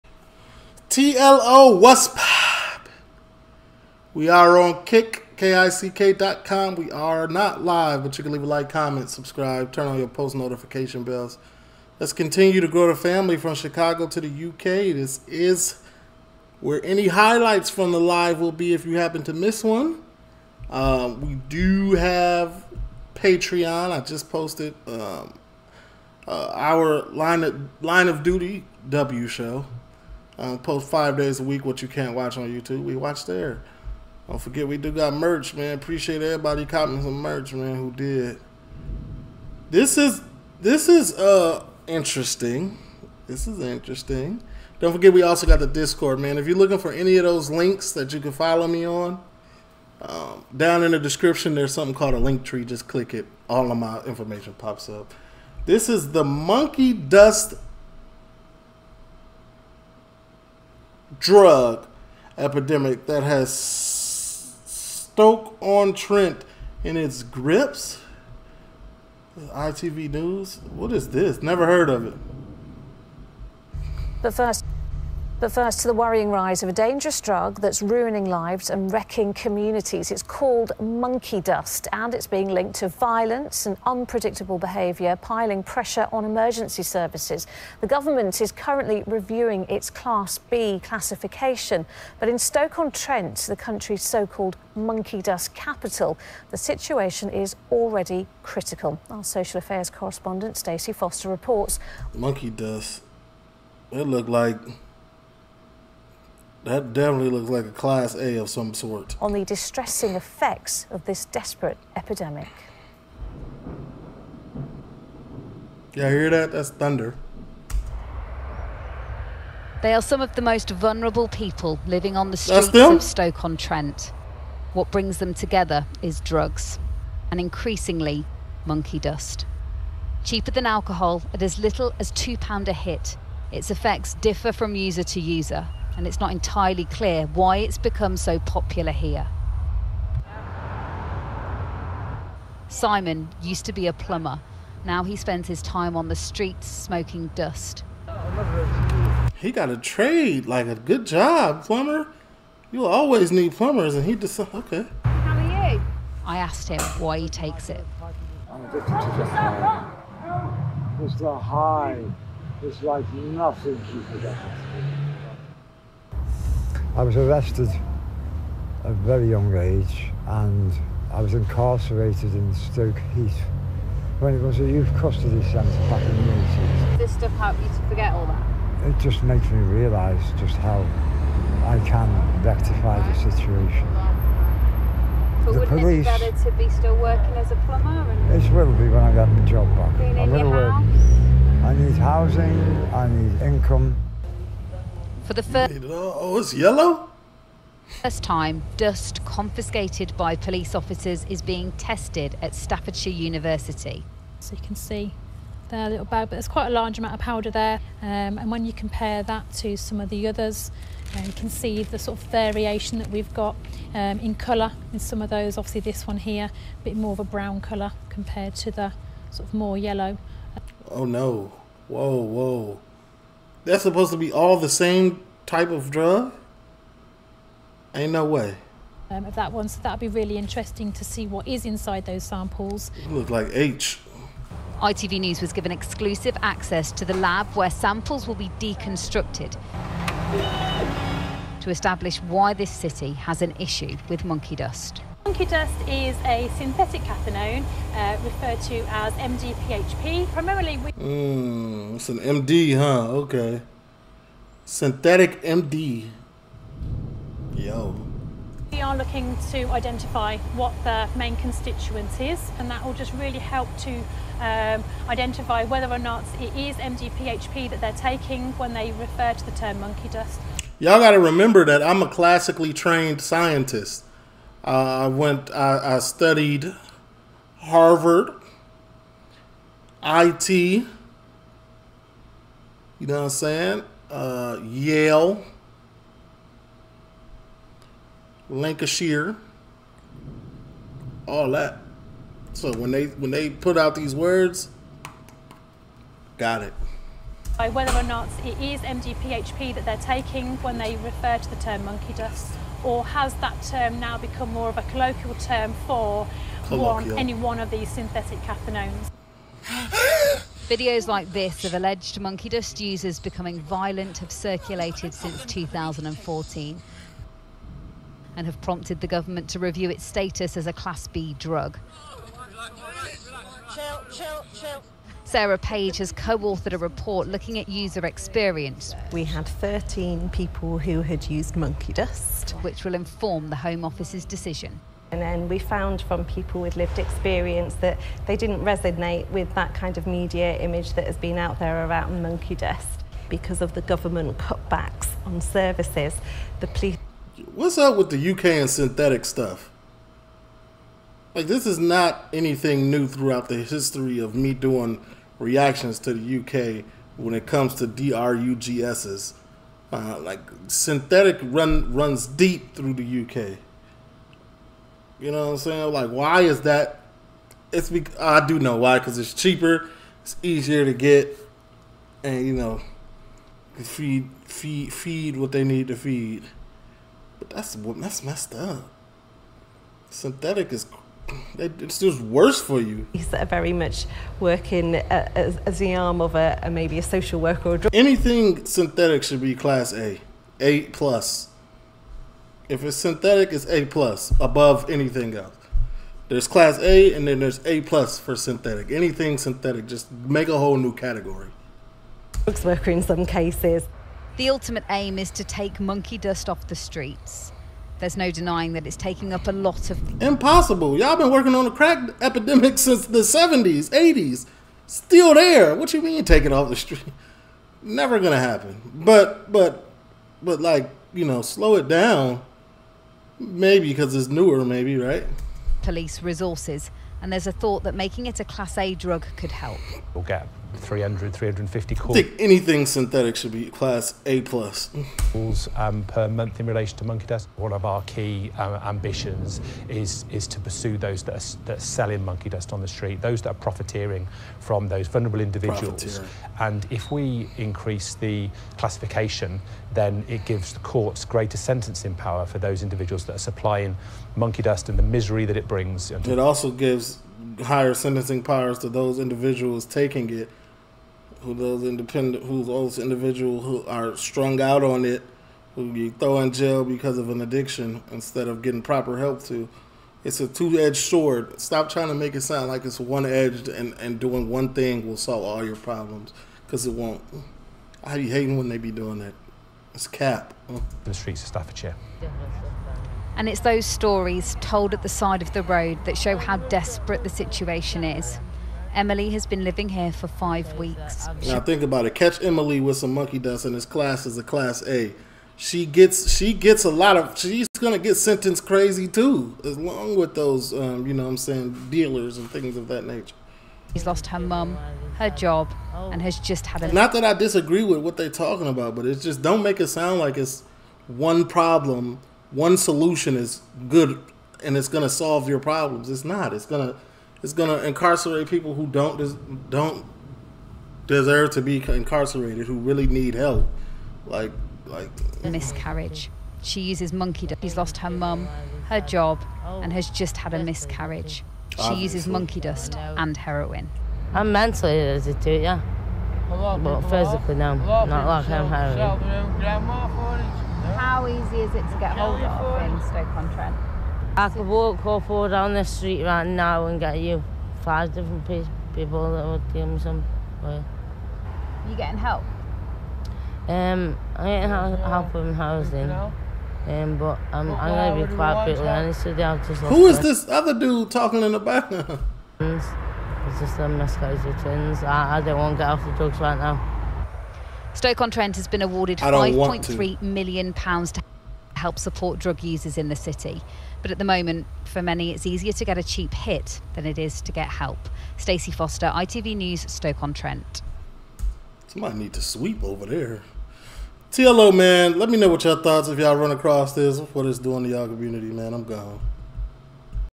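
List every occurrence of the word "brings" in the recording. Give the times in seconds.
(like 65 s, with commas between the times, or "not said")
124 s, 455 s.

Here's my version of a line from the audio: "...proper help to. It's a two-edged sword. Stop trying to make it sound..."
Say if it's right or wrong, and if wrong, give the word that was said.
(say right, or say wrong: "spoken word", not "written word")
right.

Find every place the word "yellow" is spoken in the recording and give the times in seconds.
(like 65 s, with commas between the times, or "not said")
196 s, 219 s.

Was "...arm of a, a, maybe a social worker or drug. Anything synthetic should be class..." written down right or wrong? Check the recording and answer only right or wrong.
right.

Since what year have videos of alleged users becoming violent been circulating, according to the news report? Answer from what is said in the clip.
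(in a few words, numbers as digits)
2014.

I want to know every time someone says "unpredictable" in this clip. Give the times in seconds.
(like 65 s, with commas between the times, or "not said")
83 s.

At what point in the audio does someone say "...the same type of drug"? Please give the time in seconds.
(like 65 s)
224 s.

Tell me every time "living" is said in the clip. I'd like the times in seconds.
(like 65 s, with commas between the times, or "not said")
121 s, 489 s.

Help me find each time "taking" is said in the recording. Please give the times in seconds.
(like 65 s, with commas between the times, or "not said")
267 s, 299 s, 408 s, 459 s.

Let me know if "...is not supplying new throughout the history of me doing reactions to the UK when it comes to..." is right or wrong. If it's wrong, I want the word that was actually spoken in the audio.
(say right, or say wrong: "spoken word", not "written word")
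wrong: "anything", not "supplying".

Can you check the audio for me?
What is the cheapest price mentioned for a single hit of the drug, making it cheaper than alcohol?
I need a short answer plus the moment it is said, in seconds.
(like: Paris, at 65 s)
£2, at 132 s.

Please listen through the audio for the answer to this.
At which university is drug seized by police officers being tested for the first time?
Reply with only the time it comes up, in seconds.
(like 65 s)
202 s.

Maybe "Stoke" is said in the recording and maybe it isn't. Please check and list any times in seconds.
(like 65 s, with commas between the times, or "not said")
63 s, 92 s, 123 s, 172 s, 543 s, 567 s, 579 s.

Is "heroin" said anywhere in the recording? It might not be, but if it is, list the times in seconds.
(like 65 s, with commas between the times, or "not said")
533 s, 538 s.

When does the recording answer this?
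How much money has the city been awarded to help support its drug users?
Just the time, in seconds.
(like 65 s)
569 s.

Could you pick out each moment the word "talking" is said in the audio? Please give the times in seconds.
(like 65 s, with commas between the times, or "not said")
508 s, 561 s.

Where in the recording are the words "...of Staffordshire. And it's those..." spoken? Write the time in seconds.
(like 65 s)
481 s.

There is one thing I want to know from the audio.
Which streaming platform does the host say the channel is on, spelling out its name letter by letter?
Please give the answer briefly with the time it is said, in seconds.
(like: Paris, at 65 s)
Kick, at 4 s.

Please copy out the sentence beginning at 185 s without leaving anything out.
But the wouldn't police, it be better to be still working as a plumber?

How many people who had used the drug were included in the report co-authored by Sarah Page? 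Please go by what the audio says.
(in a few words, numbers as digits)
13.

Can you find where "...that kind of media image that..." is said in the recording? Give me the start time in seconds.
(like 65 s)
339 s.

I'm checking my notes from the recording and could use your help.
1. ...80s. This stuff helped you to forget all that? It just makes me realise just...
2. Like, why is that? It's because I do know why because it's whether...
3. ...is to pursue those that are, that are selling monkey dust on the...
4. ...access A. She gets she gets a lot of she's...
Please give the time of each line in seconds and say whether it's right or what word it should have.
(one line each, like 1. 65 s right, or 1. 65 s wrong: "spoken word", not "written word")
1. 176 s right
2. 365 s wrong: "cheaper", not "whether"
3. 440 s right
4. 494 s wrong: "class", not "access".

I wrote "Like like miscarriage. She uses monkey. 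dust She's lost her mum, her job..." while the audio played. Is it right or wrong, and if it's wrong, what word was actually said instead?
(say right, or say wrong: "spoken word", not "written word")
right.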